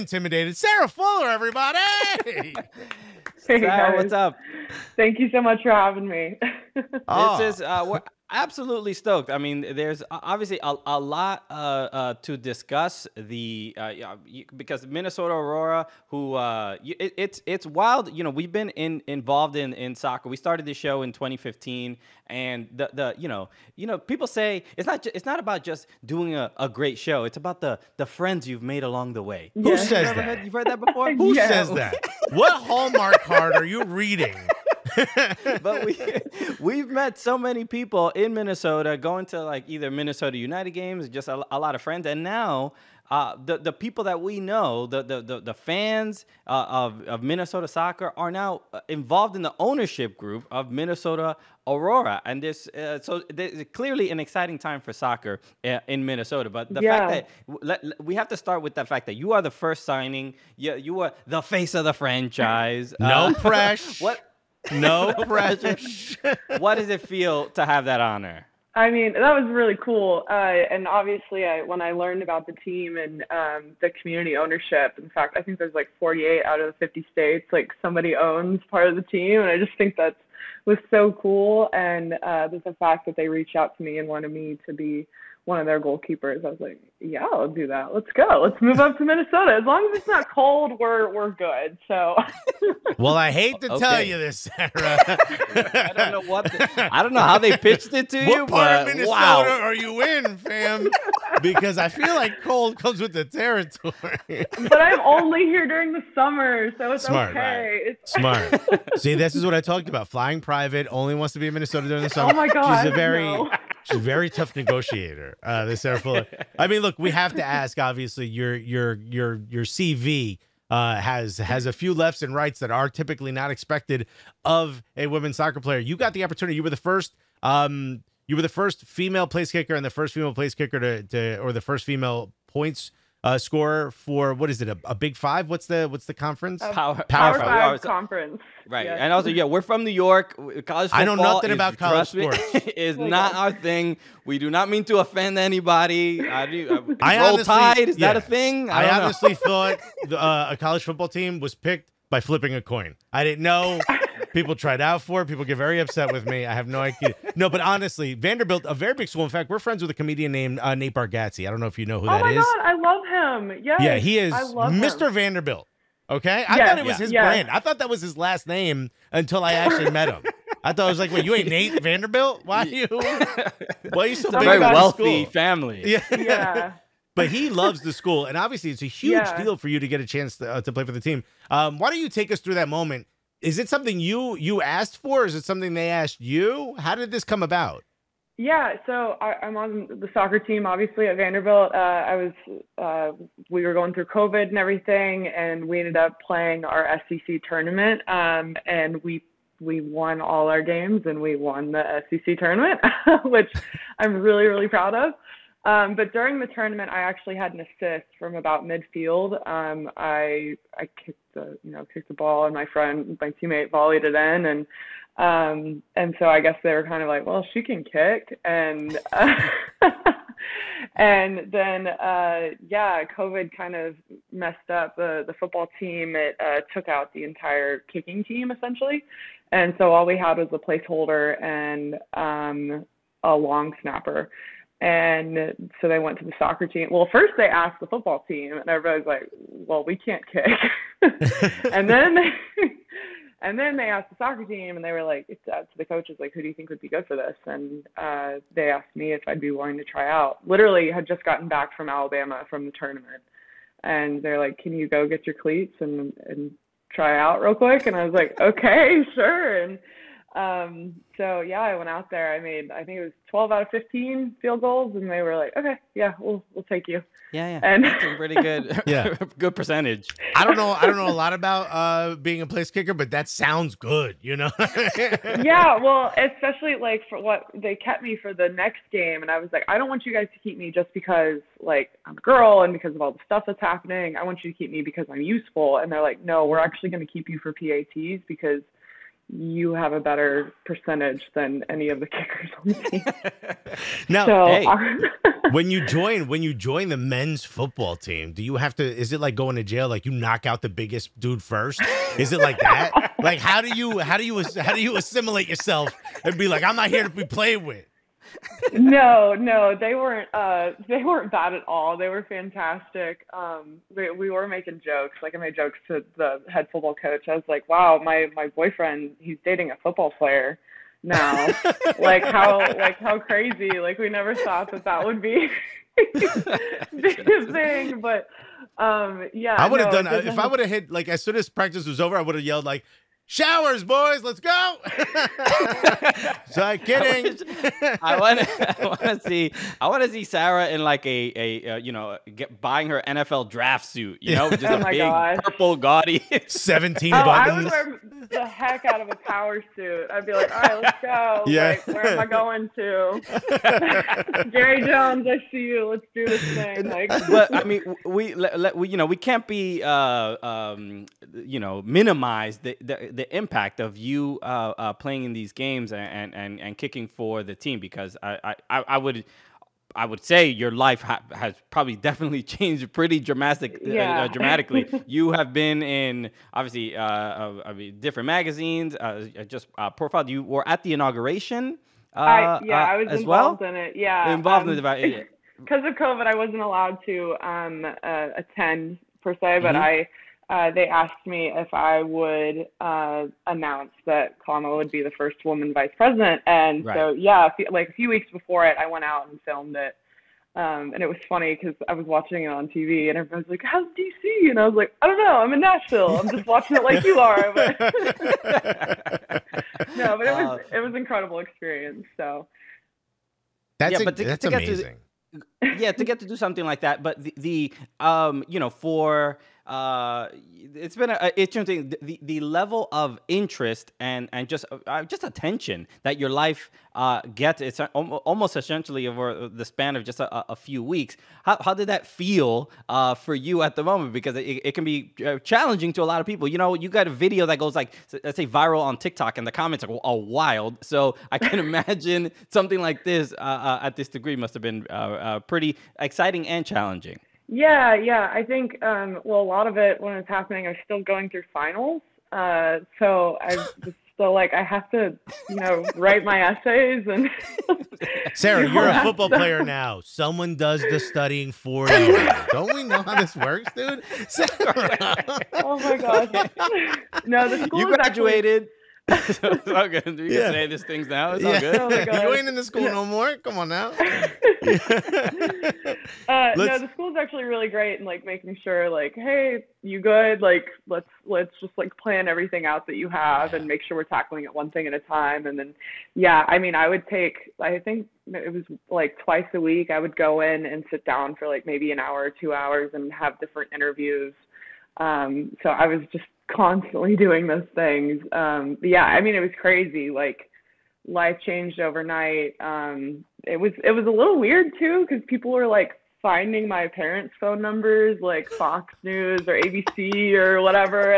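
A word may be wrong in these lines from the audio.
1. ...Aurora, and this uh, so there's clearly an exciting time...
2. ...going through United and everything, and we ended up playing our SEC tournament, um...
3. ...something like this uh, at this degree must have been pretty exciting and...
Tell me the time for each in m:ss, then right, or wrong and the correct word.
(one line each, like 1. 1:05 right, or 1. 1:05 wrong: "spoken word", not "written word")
1. 0:51 right
2. 3:13 wrong: "COVID", not "United"
3. 7:22 right.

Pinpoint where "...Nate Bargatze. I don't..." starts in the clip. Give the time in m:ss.
2:40.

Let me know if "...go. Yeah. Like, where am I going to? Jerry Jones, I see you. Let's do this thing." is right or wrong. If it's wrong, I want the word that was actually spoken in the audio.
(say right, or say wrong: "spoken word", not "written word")
right.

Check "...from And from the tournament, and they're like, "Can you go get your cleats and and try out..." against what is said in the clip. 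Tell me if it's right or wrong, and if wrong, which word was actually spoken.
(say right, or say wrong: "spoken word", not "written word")
wrong: "Alabama", not "And".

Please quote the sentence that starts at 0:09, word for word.
I mean, there's obviously a, a lot uh, uh, to discuss.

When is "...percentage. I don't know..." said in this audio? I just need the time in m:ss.
4:29.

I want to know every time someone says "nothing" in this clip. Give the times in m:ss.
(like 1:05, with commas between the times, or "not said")
2:21.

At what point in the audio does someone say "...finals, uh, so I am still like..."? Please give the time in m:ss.
7:31.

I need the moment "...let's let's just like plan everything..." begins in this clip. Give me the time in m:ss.
8:00.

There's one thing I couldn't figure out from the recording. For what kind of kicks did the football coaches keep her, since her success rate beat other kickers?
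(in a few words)
PATs.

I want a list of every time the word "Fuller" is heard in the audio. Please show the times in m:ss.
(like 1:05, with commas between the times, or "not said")
0:00, 1:55.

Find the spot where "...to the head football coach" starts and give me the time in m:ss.
5:15.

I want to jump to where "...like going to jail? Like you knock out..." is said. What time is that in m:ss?
4:59.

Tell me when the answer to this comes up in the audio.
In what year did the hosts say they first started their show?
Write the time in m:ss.
0:21.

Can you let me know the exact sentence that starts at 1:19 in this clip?
And I just think that was so cool.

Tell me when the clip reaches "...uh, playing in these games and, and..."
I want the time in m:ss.
6:04.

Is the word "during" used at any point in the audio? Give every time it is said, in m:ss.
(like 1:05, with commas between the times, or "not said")
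1:45, 1:51, 3:26.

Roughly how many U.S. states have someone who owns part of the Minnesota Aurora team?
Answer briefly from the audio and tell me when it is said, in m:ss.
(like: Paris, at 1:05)
48, at 1:15.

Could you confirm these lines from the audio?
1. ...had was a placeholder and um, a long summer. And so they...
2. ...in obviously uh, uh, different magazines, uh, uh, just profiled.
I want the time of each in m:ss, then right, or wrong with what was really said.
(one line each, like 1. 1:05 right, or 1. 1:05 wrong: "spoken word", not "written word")
1. 3:50 wrong: "snapper", not "summer"
2. 6:15 right.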